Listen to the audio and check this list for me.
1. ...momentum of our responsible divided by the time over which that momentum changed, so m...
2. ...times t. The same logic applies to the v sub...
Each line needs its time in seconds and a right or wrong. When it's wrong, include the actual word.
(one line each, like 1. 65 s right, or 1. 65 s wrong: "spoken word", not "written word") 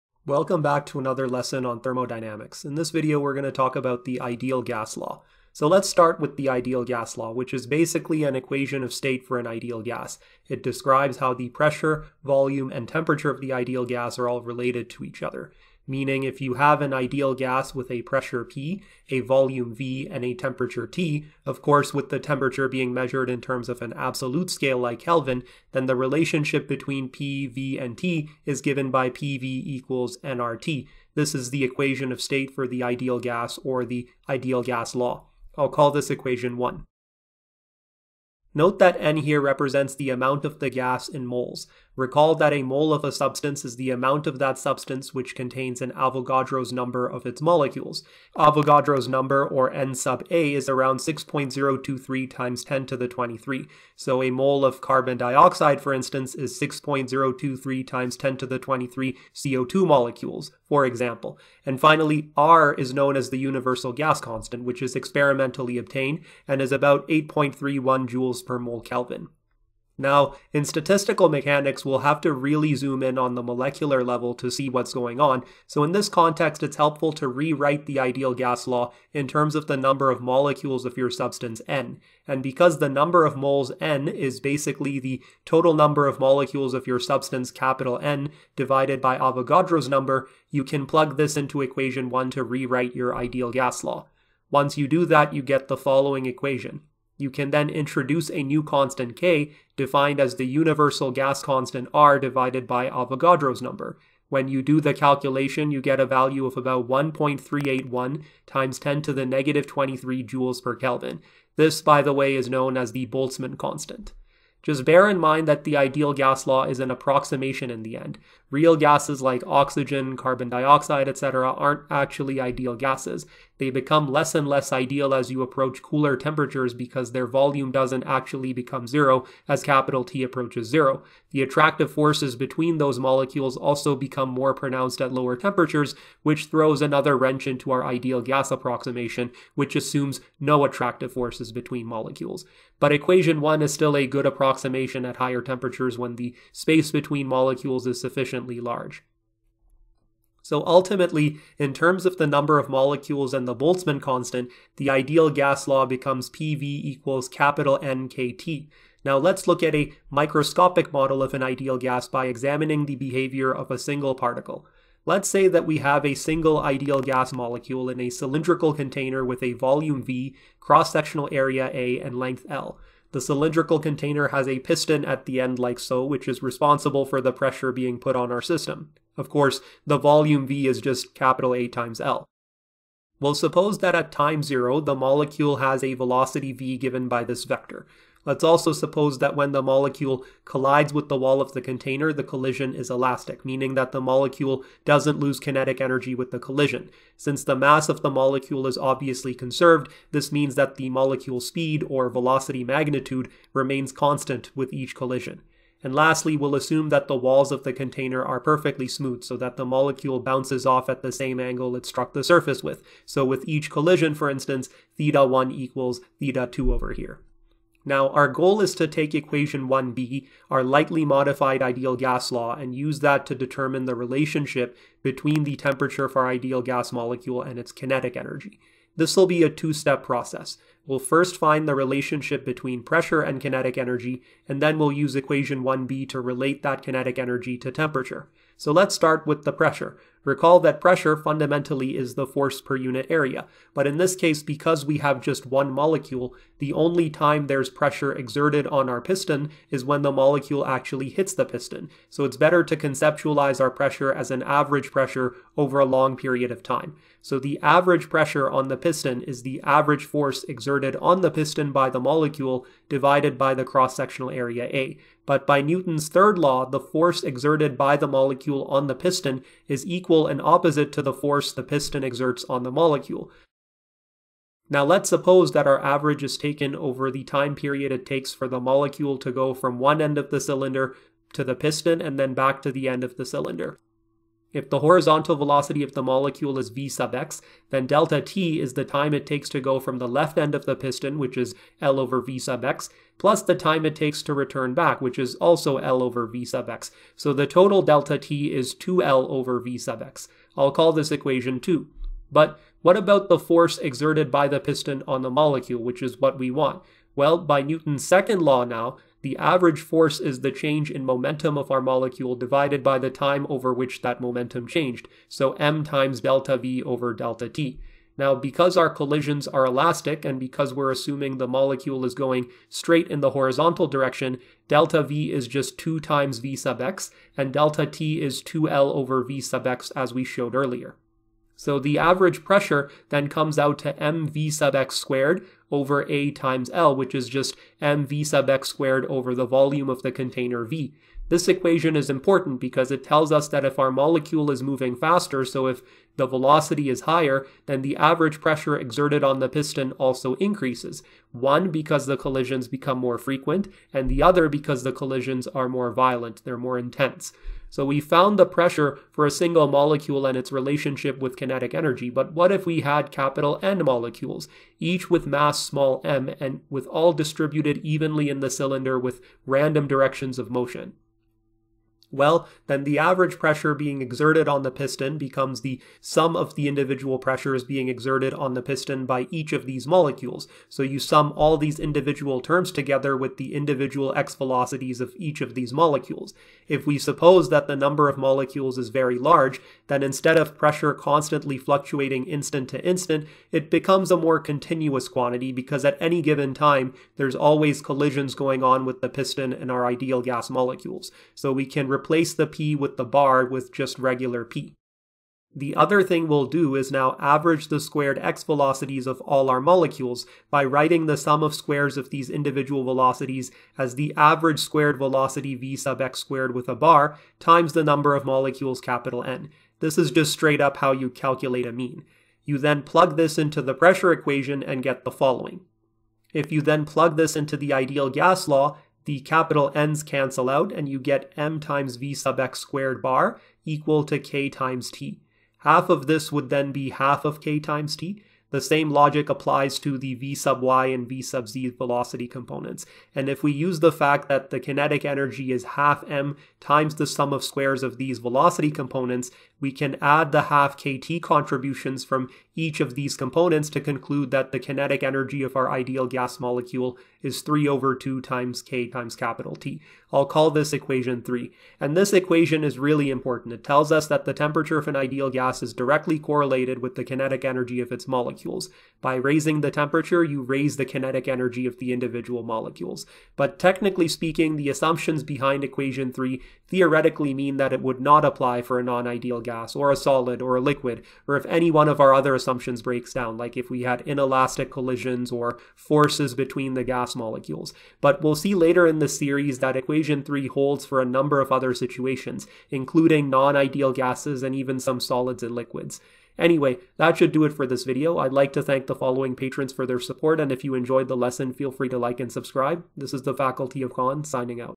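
1. 311 s wrong: "molecule", not "responsible"
2. 437 s right.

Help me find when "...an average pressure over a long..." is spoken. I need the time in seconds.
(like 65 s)
254 s.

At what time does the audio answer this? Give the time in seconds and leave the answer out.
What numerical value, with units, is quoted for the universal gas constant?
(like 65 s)
67 s.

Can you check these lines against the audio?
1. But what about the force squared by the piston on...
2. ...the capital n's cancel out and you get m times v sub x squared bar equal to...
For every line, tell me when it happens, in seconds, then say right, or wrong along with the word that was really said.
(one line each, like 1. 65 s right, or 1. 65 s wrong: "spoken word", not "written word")
1. 302 s wrong: "exerted", not "squared"
2. 429 s right.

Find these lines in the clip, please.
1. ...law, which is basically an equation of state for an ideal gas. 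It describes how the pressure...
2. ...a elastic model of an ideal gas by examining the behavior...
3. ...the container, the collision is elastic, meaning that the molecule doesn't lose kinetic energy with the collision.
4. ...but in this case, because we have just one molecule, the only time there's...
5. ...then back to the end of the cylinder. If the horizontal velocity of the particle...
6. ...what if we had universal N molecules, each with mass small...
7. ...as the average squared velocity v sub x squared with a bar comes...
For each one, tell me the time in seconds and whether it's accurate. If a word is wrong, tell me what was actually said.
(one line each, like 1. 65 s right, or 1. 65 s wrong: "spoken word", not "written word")
1. 7 s right
2. 159 s wrong: "microscopic", not "elastic"
3. 191 s right
4. 243 s right
5. 282 s wrong: "molecule", not "particle"
6. 362 s wrong: "capital", not "universal"
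7. 413 s wrong: "times", not "comes".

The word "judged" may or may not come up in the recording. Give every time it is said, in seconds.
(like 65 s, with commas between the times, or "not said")
not said.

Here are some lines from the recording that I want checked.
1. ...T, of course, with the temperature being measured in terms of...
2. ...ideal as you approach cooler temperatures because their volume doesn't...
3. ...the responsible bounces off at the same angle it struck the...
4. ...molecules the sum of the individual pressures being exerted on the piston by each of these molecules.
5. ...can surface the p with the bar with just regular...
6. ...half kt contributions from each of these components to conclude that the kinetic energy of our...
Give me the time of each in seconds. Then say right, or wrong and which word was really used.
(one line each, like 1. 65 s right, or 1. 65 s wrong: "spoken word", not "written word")
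1. 20 s right
2. 124 s right
3. 209 s wrong: "molecule", not "responsible"
4. 375 s wrong: "becomes", not "molecules"
5. 401 s wrong: "replace", not "surface"
6. 450 s right.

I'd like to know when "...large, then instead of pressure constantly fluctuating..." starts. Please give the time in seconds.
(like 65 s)
389 s.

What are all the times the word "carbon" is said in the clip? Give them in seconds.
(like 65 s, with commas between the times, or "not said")
54 s, 120 s.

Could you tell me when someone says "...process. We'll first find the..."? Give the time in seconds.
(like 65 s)
230 s.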